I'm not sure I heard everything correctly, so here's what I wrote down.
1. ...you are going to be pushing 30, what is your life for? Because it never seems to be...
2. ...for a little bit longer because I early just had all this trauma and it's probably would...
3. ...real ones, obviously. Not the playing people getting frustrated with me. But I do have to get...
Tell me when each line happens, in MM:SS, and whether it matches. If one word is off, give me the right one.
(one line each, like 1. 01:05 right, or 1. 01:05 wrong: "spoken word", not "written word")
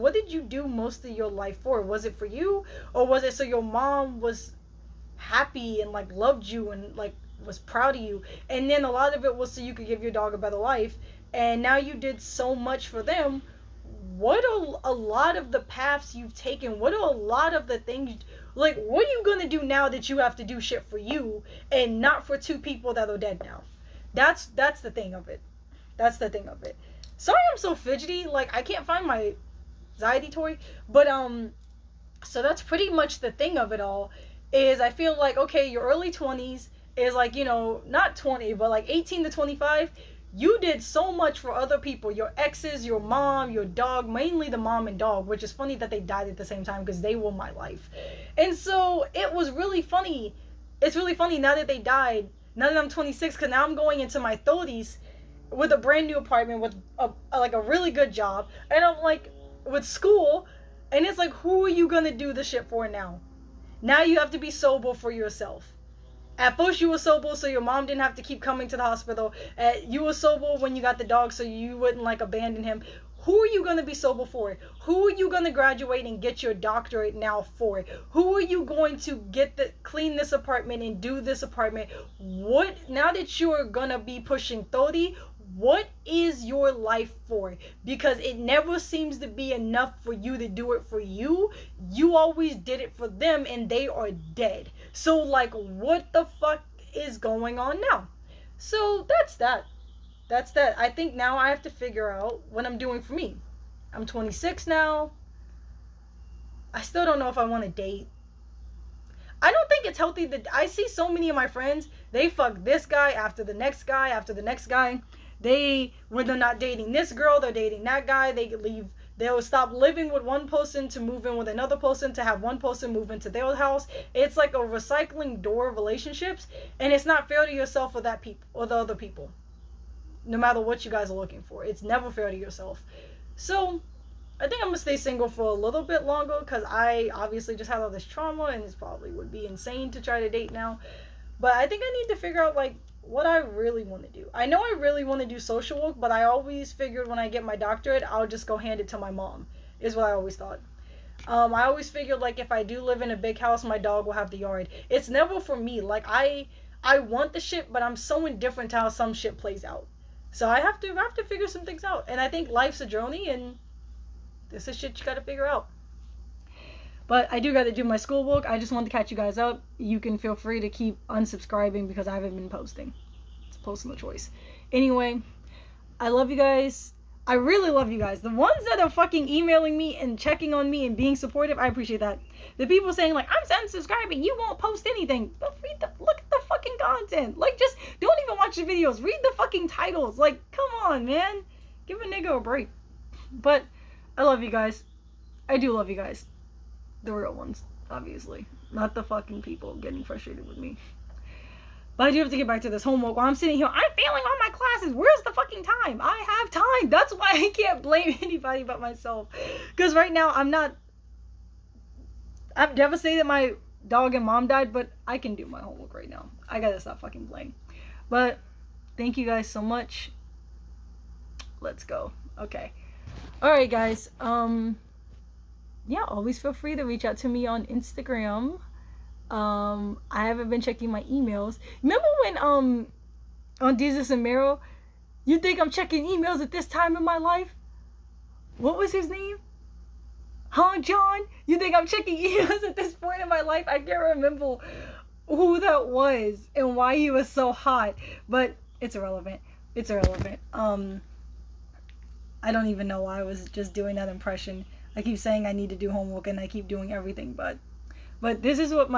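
1. 01:23 right
2. 02:15 wrong: "obviously", not "early"
3. 03:17 wrong: "fucking", not "playing".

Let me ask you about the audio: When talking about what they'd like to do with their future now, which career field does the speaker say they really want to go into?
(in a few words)
social work.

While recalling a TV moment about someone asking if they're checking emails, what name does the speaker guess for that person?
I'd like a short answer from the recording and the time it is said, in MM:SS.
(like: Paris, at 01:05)
John, at 04:00.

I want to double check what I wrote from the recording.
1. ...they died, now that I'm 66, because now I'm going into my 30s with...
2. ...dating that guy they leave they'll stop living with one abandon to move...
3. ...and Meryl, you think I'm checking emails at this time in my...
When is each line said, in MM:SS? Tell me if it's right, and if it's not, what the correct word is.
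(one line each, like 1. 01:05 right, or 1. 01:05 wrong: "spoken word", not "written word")
1. 00:51 wrong: "26", not "66"
2. 01:57 wrong: "person", not "abandon"
3. 03:54 right.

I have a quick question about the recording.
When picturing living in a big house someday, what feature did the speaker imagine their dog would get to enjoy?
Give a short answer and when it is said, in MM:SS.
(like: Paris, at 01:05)
the yard, at 02:34.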